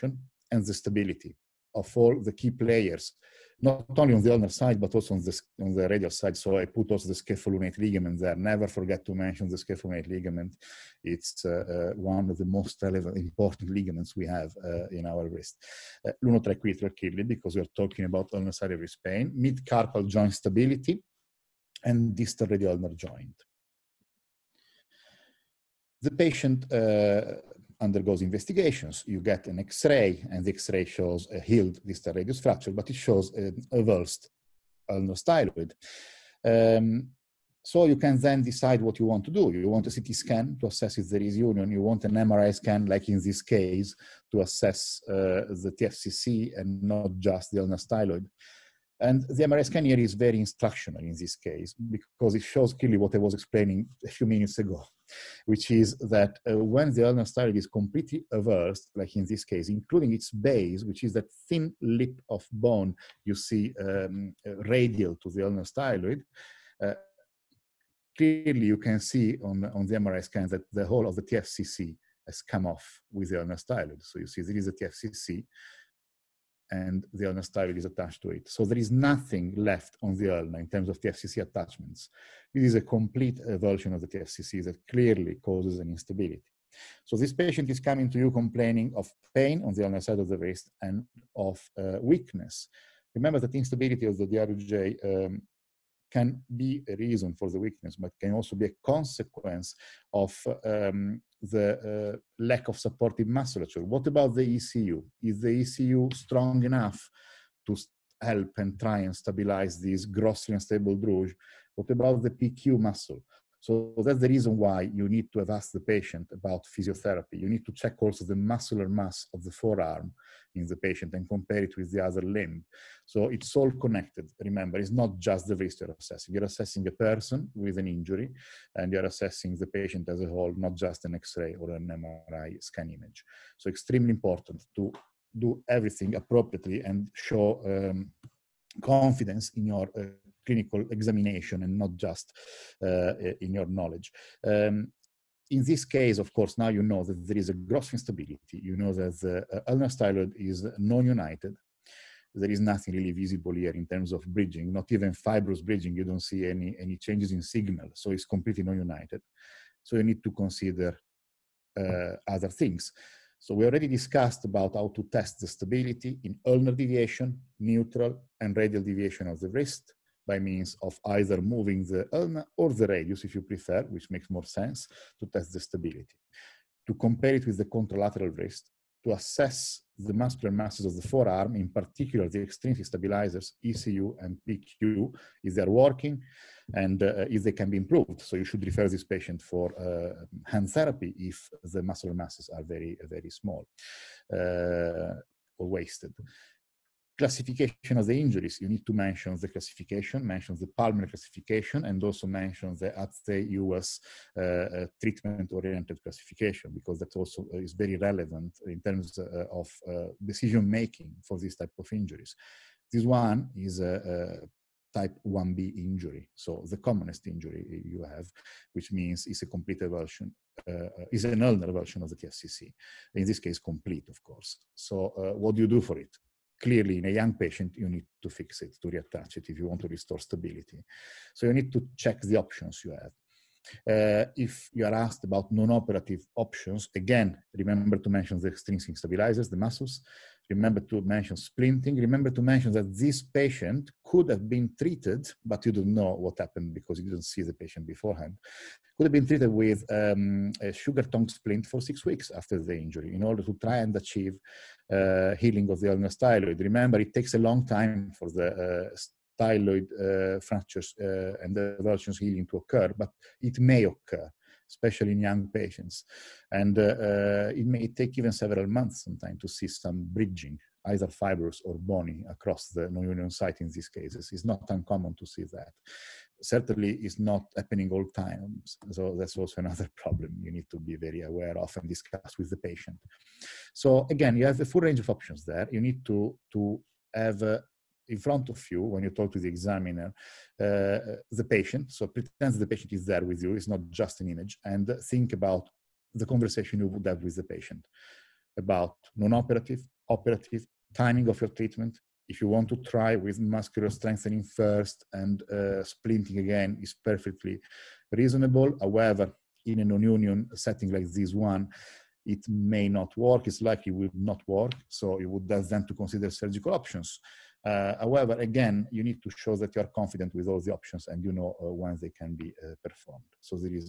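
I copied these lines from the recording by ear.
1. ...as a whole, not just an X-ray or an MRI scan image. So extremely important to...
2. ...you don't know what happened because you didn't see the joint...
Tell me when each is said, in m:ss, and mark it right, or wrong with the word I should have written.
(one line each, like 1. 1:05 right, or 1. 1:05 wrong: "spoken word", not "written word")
1. 2:10 right
2. 4:05 wrong: "patient", not "joint".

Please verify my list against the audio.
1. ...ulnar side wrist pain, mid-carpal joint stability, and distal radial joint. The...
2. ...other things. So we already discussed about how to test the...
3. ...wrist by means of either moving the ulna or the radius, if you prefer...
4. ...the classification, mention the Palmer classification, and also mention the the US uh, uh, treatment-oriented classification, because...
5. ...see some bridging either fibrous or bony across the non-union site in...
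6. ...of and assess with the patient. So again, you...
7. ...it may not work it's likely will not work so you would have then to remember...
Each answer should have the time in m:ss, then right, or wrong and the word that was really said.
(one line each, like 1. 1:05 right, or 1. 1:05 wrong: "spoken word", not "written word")
1. 0:18 right
2. 2:42 right
3. 2:49 right
4. 3:19 right
5. 4:29 right
6. 4:41 wrong: "discuss", not "assess"
7. 5:12 wrong: "consider", not "remember".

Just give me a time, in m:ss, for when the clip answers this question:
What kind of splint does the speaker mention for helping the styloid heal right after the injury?
4:10.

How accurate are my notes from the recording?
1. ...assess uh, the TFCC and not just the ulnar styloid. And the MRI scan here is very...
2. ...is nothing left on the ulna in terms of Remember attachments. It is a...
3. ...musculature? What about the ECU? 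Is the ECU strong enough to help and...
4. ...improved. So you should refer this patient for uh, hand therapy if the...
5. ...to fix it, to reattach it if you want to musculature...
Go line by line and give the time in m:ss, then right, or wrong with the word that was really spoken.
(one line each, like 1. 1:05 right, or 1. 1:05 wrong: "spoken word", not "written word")
1. 0:44 right
2. 1:18 wrong: "TFCC", not "Remember"
3. 1:43 right
4. 3:07 right
5. 3:48 wrong: "restore", not "musculature".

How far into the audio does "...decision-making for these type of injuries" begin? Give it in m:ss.
3:30.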